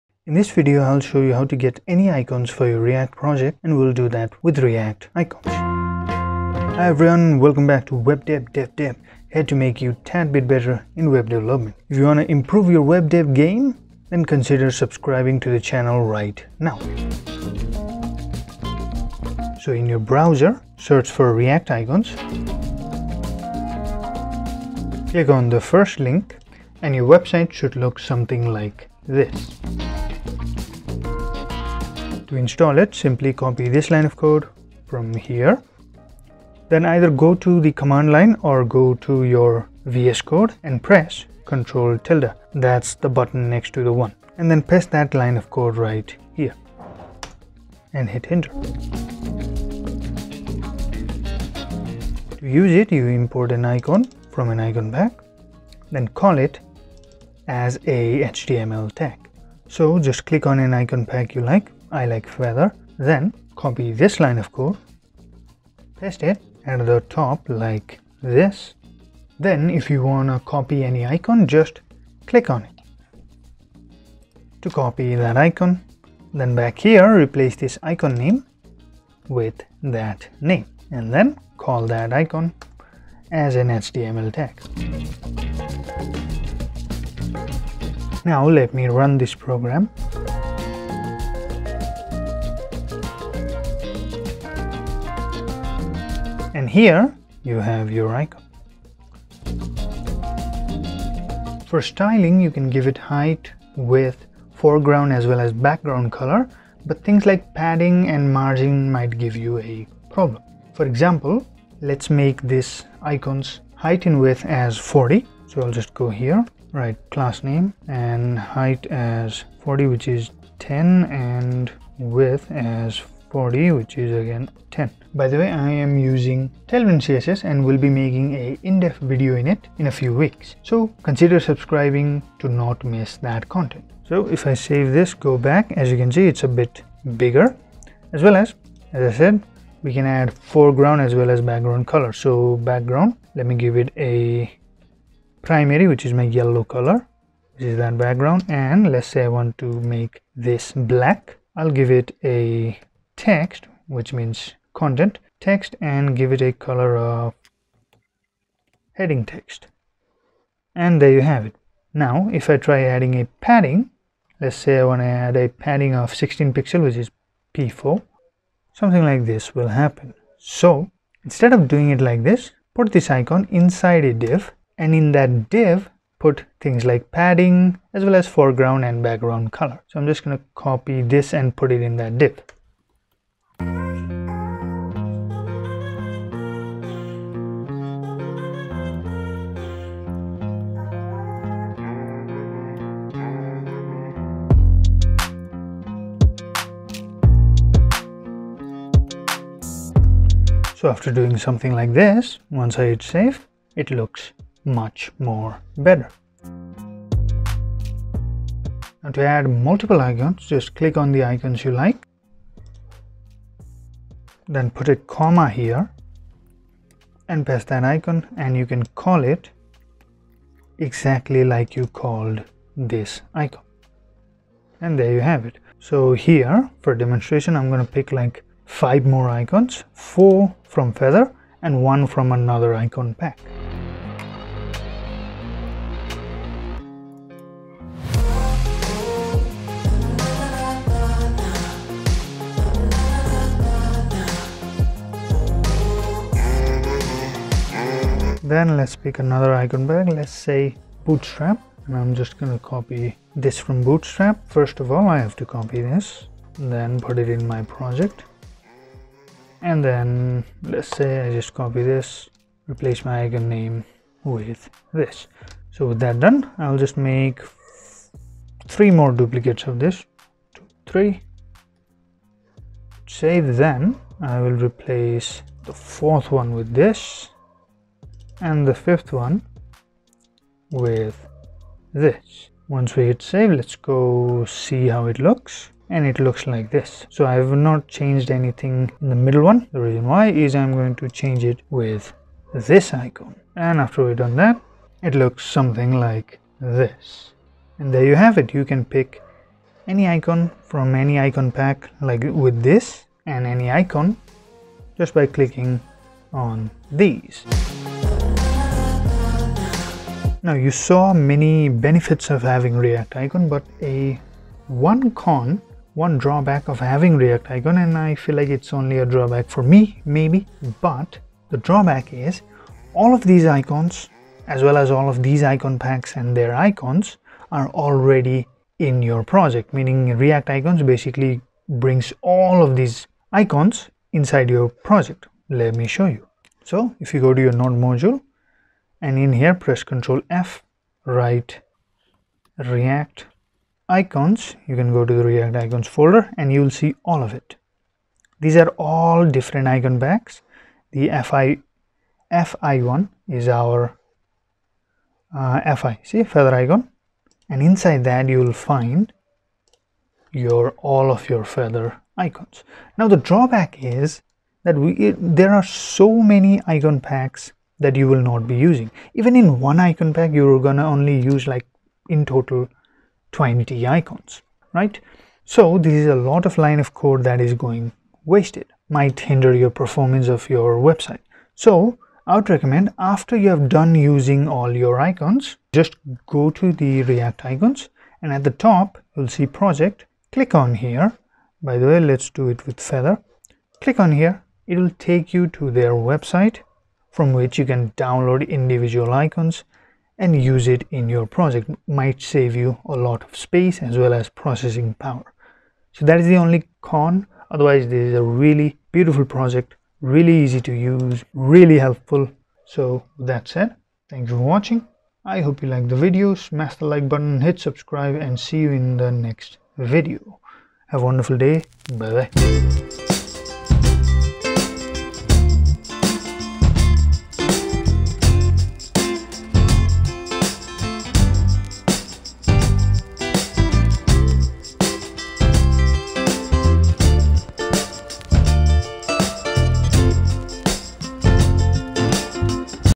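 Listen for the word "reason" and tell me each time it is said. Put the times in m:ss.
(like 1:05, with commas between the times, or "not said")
4:49.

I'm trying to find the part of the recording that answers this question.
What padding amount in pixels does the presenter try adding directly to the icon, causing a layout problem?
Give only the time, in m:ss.
2:46.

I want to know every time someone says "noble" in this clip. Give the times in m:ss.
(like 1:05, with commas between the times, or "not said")
not said.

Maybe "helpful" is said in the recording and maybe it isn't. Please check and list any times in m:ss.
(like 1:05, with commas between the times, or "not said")
6:51.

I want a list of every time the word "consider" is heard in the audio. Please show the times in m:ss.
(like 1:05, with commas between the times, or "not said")
0:14, 2:11.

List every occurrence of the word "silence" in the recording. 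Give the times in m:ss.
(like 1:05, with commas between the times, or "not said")
not said.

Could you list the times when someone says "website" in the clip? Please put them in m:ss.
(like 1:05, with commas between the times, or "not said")
0:27, 6:20, 6:36.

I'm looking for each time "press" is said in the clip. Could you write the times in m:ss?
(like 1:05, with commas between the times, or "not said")
0:40, 5:39.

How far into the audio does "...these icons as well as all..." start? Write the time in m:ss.
5:23.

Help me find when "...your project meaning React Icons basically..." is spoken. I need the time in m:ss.
5:29.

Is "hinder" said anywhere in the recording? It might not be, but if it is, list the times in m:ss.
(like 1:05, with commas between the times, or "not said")
6:19.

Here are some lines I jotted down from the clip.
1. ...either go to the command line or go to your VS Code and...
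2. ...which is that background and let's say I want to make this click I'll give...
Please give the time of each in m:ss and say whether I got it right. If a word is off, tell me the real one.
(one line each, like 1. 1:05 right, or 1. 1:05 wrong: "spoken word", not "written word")
1. 0:36 right
2. 2:27 wrong: "black", not "click".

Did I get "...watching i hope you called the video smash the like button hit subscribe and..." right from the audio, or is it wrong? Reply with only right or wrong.
wrong.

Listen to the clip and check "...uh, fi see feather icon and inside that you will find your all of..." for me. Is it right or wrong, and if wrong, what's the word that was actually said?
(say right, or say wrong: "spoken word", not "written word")
right.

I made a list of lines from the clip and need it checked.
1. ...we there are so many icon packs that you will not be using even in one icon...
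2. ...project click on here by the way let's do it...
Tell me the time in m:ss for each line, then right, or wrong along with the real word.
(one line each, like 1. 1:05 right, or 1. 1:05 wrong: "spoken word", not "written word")
1. 6:04 right
2. 6:29 right.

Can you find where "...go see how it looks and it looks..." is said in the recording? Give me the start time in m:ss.
4:43.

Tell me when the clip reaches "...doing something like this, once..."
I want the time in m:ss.
3:21.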